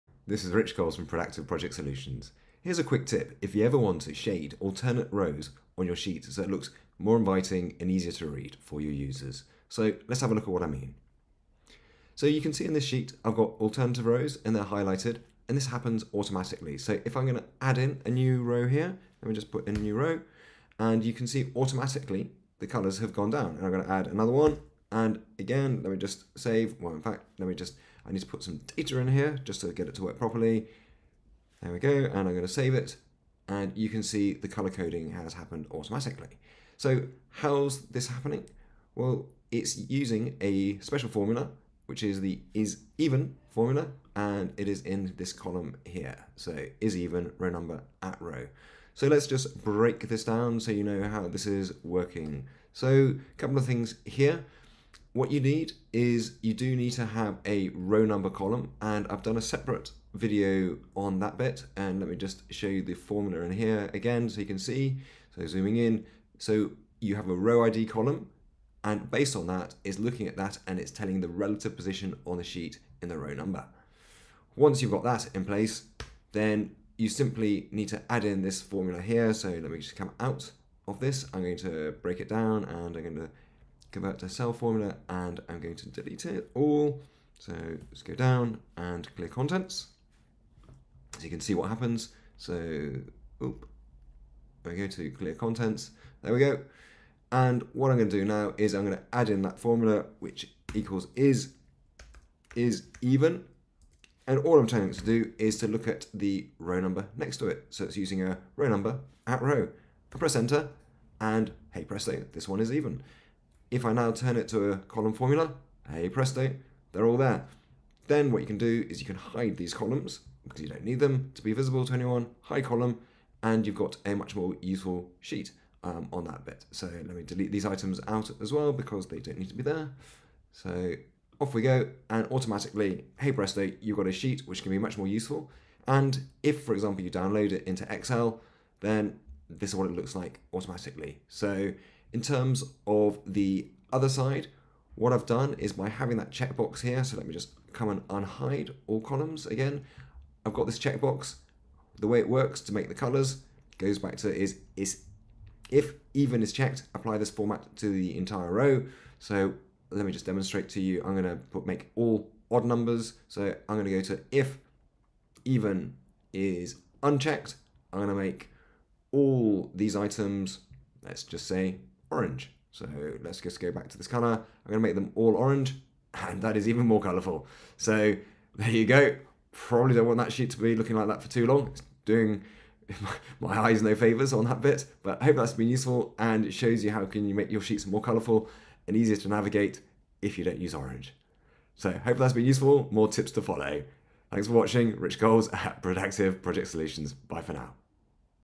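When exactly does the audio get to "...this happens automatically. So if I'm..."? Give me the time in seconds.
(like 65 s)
15 s.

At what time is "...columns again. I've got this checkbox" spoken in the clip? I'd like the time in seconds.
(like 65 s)
148 s.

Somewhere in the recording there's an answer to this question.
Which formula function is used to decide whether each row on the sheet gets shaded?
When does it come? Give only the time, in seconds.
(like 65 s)
42 s.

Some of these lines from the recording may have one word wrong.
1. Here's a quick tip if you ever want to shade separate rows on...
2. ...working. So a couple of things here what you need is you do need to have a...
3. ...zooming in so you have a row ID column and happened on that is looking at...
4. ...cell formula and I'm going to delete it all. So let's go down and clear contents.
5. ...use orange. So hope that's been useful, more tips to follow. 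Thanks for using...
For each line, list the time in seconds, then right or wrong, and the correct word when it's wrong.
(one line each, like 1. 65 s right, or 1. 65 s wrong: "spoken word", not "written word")
1. 2 s wrong: "alternate", not "separate"
2. 51 s right
3. 65 s wrong: "based", not "happened"
4. 84 s right
5. 190 s wrong: "watching", not "using".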